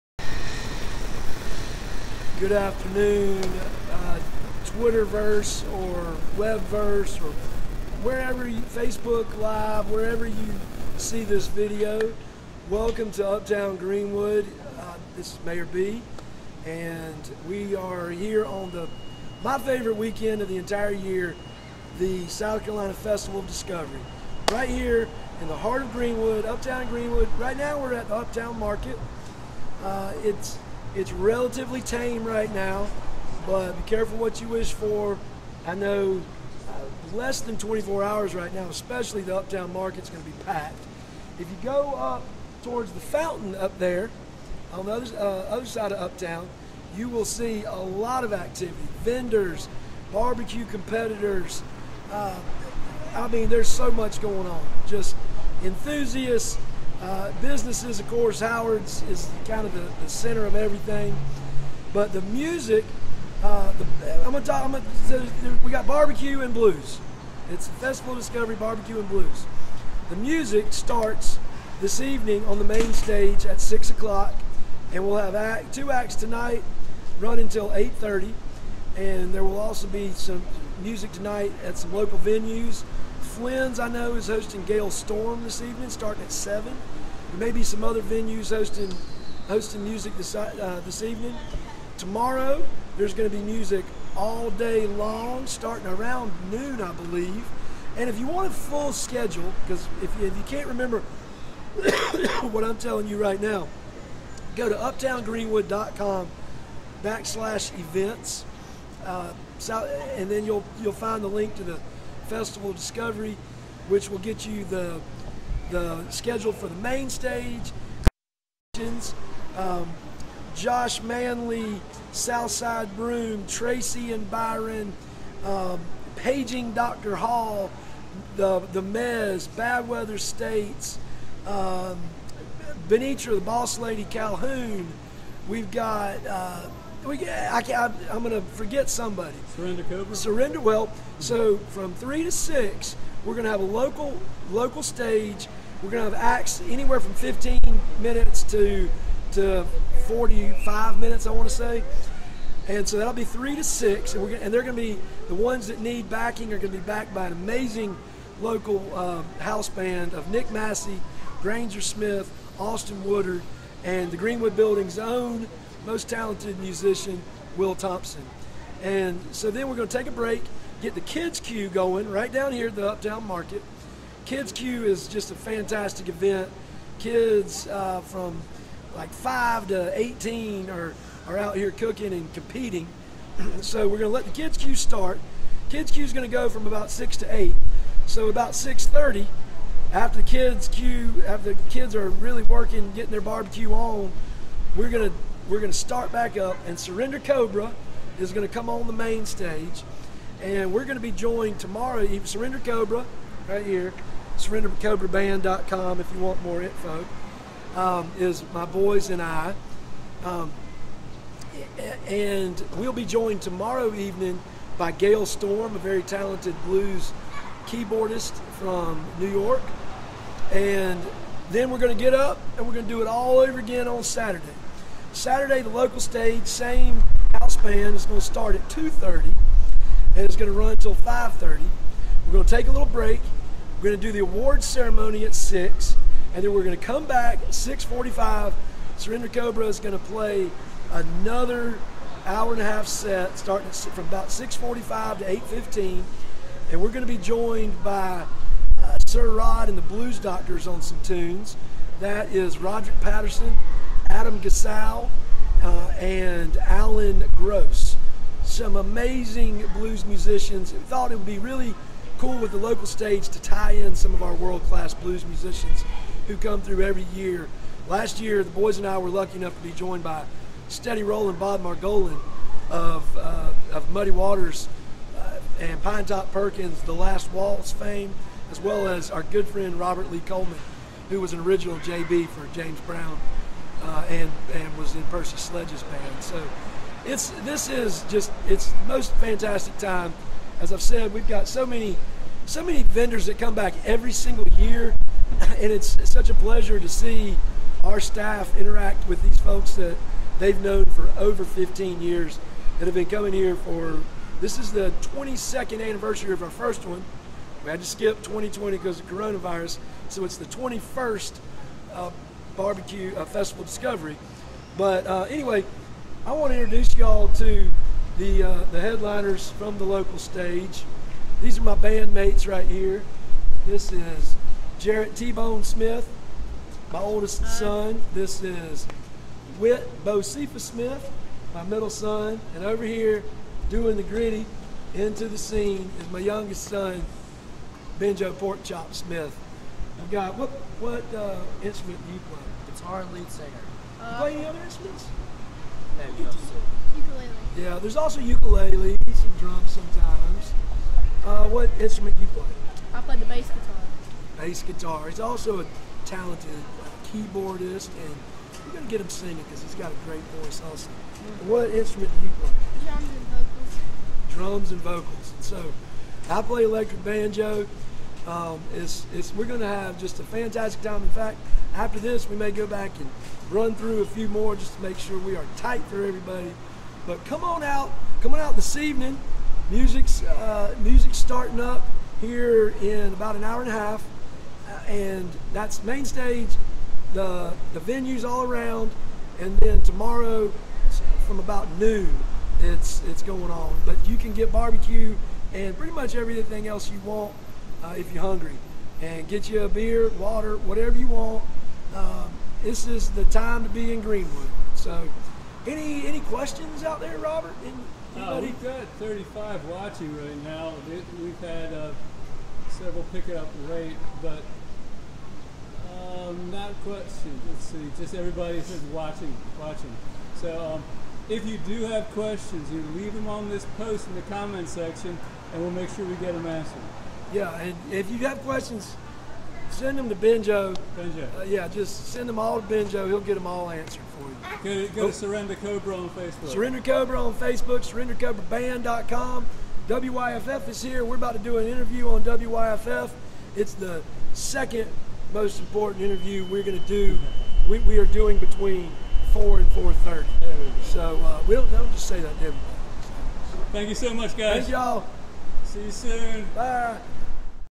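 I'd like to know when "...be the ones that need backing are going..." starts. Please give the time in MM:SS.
02:34.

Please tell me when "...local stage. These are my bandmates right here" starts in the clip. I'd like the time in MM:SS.
05:19.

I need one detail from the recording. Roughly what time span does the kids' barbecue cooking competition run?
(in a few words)
6 to 8.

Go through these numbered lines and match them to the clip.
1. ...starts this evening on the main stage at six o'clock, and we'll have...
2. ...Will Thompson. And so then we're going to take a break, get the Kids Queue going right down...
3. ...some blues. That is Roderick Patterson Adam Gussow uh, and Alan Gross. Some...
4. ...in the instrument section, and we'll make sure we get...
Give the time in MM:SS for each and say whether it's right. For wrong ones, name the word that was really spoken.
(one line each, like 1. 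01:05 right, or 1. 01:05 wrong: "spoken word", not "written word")
1. 01:10 right
2. 02:47 right
3. 04:10 wrong: "tunes", not "blues"
4. 07:04 wrong: "comment", not "instrument".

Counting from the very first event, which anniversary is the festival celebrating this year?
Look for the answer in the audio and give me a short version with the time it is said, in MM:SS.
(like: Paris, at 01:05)
22nd, at 05:05.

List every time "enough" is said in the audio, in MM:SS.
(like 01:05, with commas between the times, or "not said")
04:29.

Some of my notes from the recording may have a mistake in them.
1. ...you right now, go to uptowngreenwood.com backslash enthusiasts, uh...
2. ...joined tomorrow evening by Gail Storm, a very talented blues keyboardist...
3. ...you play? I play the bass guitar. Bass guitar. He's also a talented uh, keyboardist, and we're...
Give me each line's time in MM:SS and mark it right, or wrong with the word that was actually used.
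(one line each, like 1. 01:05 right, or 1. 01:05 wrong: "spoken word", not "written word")
1. 01:43 wrong: "events", not "enthusiasts"
2. 03:33 right
3. 05:52 right.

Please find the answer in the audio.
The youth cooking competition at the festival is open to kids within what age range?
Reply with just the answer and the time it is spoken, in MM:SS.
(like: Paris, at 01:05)
5 to 18, at 02:59.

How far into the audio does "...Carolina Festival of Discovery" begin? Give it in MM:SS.
00:22.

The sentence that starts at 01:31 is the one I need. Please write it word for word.
Tomorrow, there's going to be music all day long, starting around noon, I believe.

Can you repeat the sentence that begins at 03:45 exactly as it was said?
Saturday, the local stage, same house band.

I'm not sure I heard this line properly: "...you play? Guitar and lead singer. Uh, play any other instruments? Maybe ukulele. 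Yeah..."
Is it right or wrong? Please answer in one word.
right.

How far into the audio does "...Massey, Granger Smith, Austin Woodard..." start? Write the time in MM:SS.
02:40.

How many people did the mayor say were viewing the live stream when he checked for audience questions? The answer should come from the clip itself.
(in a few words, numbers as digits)
35.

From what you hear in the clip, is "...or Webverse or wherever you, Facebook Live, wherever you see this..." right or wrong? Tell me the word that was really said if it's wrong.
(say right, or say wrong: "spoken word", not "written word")
right.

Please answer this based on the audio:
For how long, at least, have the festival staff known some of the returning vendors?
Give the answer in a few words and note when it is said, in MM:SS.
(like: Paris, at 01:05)
15 years, at 05:01.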